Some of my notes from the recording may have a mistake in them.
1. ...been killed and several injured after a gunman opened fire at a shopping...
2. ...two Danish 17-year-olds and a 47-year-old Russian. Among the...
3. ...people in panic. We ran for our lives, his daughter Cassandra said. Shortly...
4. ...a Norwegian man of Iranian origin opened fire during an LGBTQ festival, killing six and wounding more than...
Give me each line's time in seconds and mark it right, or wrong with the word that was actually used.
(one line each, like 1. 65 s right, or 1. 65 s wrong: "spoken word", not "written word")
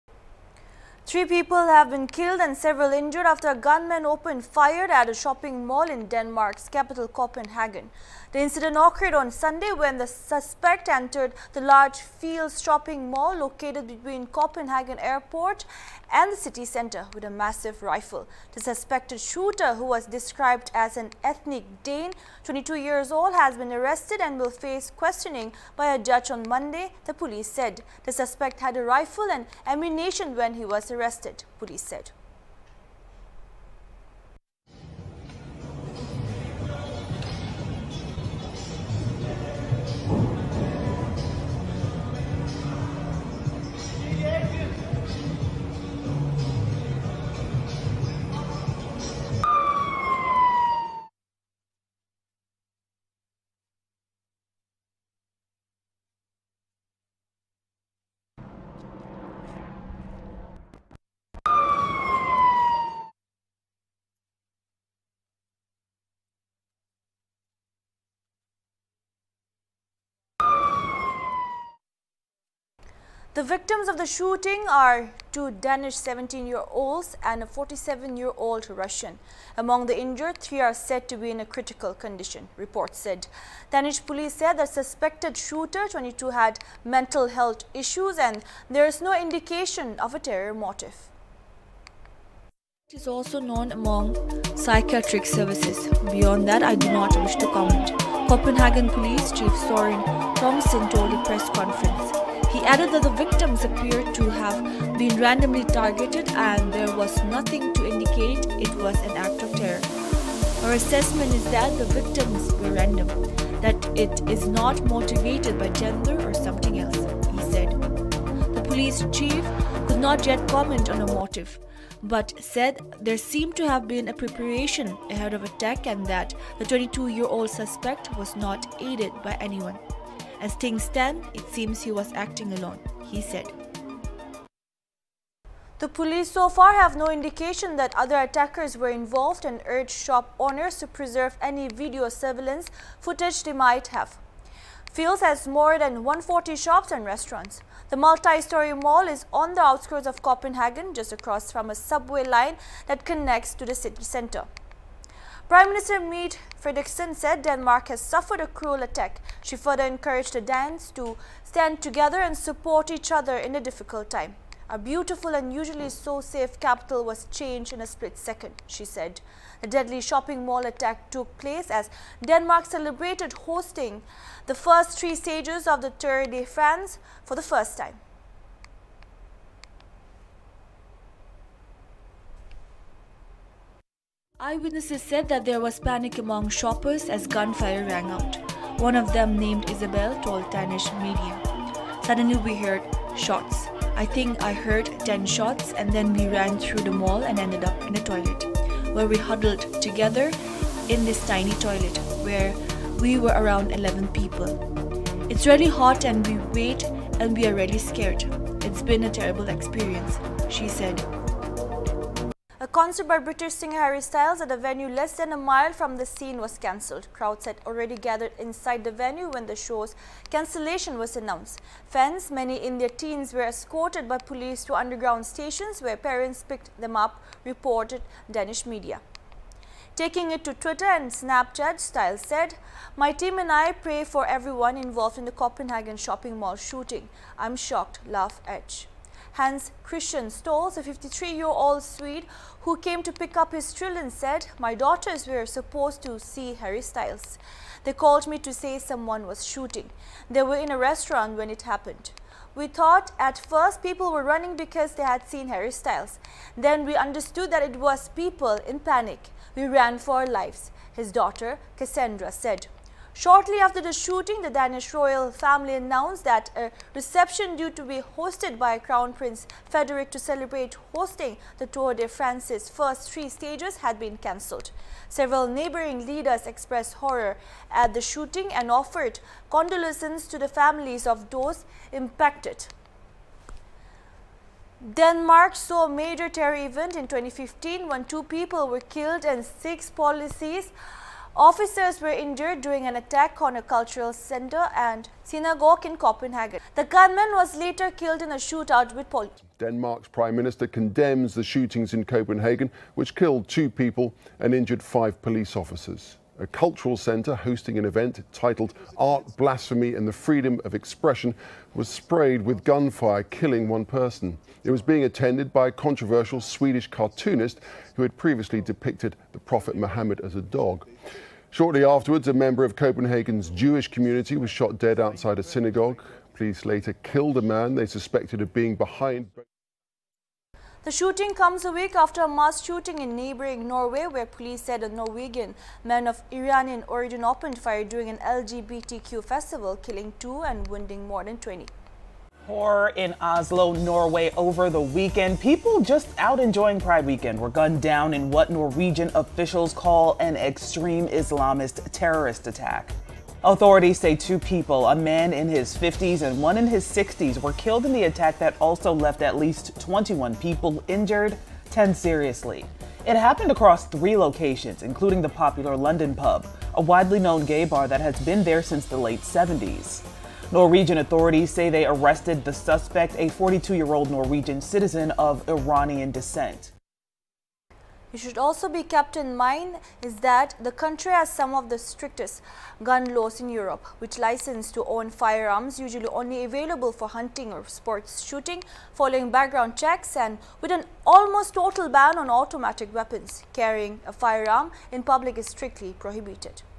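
1. 1 s right
2. 75 s right
3. 258 s right
4. 334 s wrong: "two", not "six".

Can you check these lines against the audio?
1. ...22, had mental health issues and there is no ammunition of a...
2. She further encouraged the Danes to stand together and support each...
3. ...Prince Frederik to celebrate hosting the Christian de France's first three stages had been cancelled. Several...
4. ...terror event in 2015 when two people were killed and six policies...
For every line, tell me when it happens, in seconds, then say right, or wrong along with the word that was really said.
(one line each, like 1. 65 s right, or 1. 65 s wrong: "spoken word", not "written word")
1. 85 s wrong: "indication", not "ammunition"
2. 159 s right
3. 269 s wrong: "Tour", not "Christian"
4. 286 s right.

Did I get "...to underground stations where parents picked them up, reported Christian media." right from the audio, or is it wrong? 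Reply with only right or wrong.
wrong.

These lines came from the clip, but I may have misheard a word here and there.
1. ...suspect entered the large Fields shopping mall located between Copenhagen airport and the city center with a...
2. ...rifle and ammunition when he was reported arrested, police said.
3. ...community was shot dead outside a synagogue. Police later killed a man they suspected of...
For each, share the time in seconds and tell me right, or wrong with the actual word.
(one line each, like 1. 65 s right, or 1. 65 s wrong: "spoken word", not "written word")
1. 10 s right
2. 28 s wrong: "arrested", not "reported"
3. 323 s right.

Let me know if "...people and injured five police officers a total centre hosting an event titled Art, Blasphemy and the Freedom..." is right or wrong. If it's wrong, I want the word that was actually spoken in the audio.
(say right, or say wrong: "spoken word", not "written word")
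wrong: "cultural", not "total".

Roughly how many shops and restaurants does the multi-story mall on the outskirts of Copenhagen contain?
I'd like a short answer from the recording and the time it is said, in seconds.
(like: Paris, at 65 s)
More than 140, at 146 s.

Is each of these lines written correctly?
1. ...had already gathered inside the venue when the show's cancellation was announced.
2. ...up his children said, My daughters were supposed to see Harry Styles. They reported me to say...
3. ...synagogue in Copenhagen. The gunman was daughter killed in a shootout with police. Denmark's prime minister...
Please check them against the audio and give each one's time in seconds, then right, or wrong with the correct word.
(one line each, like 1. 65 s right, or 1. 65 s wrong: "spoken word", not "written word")
1. 217 s right
2. 243 s wrong: "called", not "reported"
3. 295 s wrong: "later", not "daughter".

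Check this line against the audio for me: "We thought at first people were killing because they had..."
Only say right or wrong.
wrong.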